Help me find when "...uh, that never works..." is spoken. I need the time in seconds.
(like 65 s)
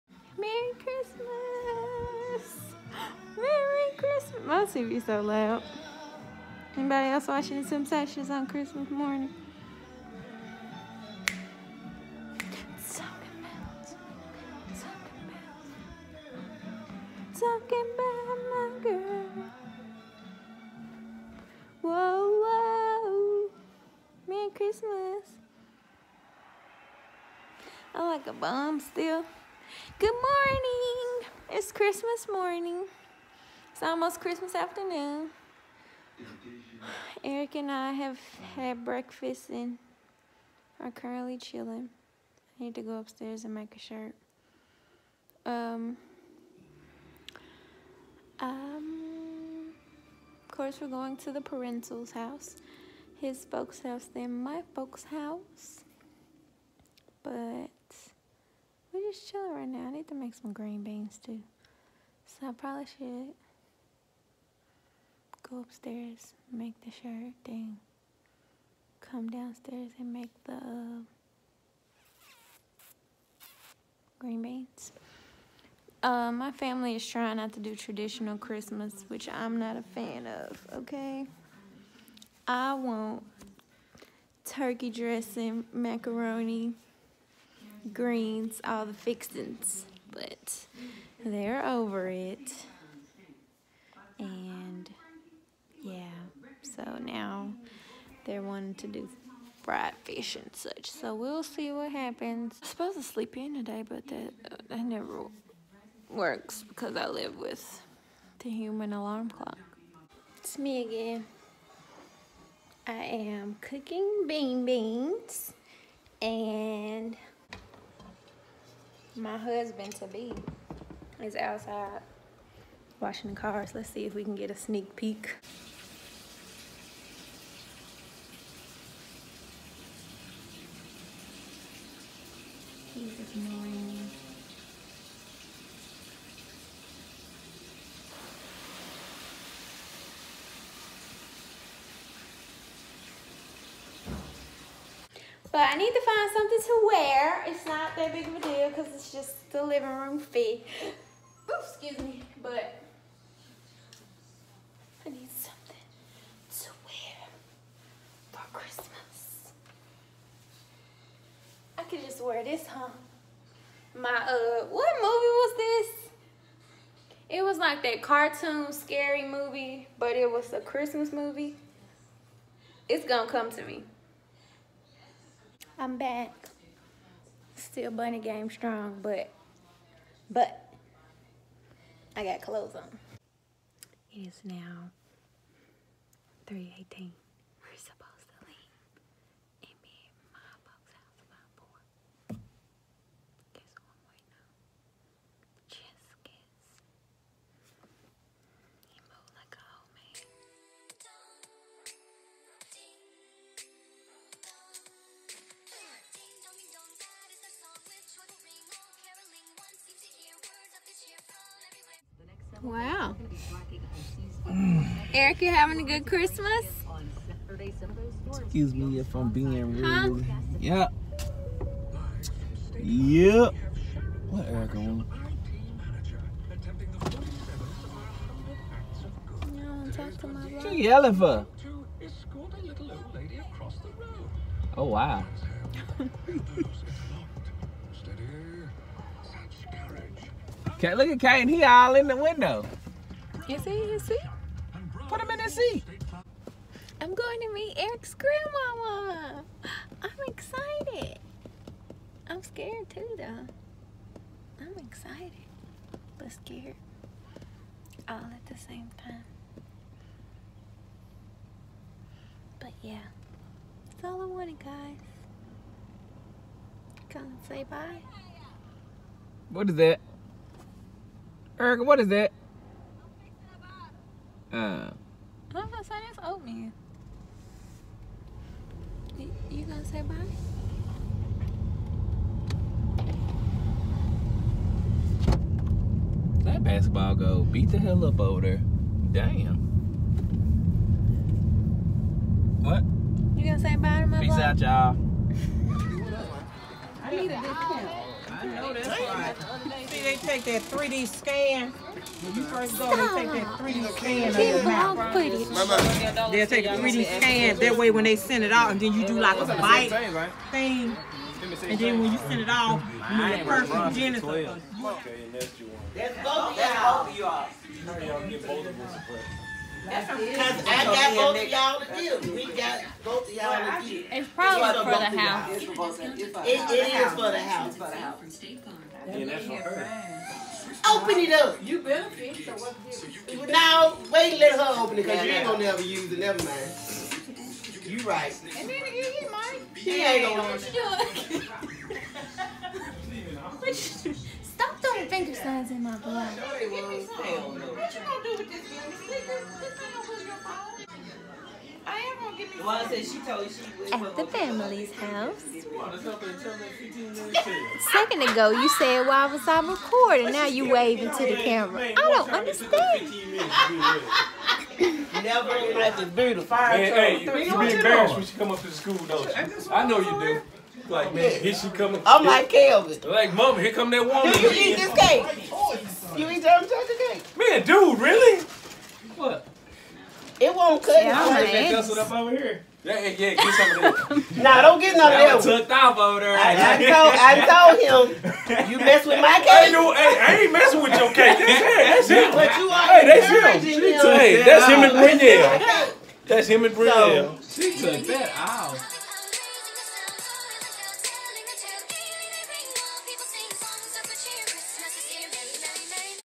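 104 s.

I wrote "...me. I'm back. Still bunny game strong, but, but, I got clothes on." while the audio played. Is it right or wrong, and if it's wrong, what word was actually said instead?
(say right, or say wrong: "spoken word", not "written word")
right.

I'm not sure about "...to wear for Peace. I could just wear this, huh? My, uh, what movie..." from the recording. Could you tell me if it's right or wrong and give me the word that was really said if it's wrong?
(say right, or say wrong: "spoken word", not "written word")
wrong: "Christmas", not "Peace".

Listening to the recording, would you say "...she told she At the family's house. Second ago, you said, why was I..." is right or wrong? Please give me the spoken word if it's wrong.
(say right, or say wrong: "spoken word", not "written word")
right.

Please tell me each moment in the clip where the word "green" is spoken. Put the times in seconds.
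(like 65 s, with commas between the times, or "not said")
60 s, 74 s, 87 s.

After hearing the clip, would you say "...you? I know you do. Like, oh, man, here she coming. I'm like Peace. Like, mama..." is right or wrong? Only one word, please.
wrong.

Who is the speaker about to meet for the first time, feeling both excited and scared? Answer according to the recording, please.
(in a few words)
Eric's grandmama.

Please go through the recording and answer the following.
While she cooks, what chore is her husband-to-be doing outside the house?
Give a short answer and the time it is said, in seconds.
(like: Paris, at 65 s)
washing the cars, at 122 s.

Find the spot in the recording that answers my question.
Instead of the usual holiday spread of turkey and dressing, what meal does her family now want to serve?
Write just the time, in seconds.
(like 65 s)
99 s.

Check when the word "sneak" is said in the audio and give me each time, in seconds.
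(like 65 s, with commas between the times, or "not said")
124 s.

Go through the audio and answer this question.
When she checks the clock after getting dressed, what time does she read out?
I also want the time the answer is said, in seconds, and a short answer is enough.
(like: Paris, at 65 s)
3:18, at 186 s.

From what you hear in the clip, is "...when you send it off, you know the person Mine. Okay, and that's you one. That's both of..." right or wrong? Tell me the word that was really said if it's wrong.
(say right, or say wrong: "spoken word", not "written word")
wrong: "Jennifer", not "Mine".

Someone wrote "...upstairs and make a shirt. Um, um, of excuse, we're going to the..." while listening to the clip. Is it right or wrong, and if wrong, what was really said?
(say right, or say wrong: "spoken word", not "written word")
wrong: "course", not "excuse".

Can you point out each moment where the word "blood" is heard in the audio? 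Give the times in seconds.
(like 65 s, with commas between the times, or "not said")
345 s.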